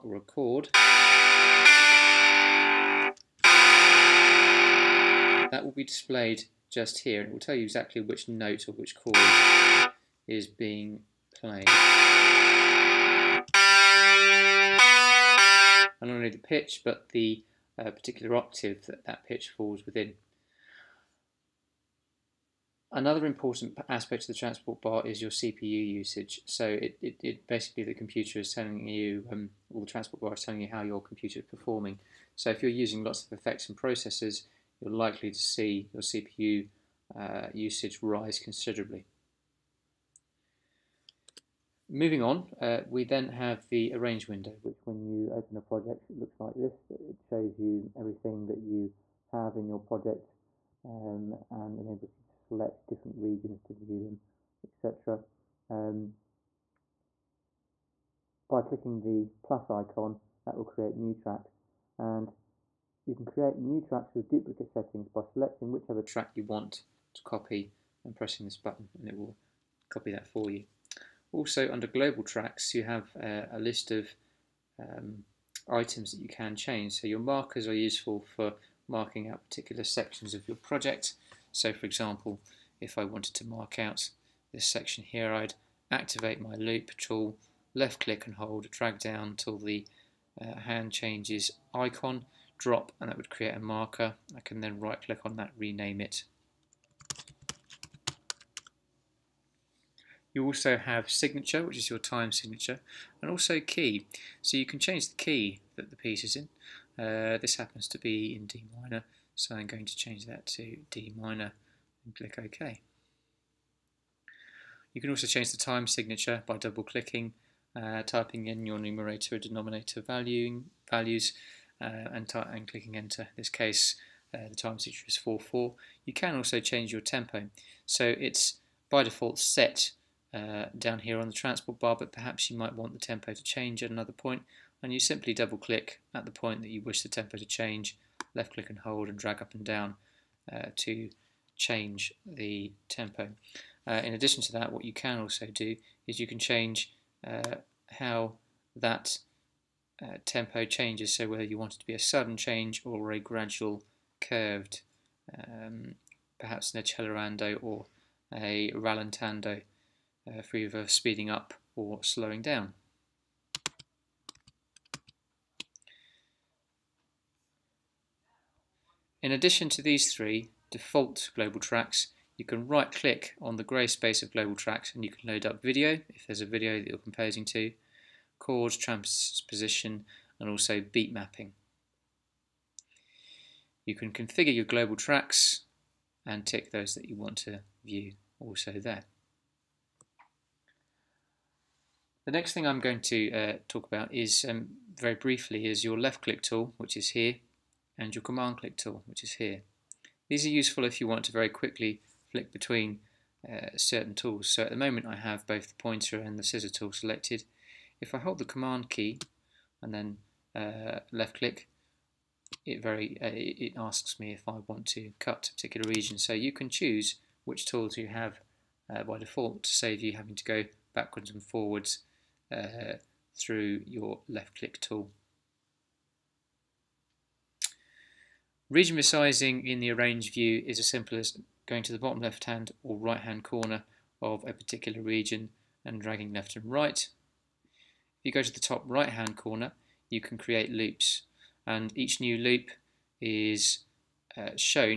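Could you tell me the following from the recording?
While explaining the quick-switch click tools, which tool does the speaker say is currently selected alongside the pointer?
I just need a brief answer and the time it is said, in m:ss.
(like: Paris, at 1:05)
Scissor tool, at 3:26.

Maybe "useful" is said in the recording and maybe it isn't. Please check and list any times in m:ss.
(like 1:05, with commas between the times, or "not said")
1:17, 3:20.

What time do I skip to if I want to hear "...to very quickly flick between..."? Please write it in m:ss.
3:21.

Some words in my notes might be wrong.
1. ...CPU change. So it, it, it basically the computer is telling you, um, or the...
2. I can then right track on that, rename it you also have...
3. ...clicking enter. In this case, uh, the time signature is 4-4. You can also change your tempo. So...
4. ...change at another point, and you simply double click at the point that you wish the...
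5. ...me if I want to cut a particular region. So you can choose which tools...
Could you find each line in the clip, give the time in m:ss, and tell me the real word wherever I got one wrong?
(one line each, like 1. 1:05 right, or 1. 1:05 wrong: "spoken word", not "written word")
1. 0:25 wrong: "usage", not "change"
2. 1:34 wrong: "click", not "track"
3. 2:02 right
4. 2:13 right
5. 3:34 right.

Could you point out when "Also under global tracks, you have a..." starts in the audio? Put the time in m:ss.
1:11.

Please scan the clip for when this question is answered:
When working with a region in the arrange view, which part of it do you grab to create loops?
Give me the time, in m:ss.
3:58.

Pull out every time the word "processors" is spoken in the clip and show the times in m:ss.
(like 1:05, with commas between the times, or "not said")
0:33.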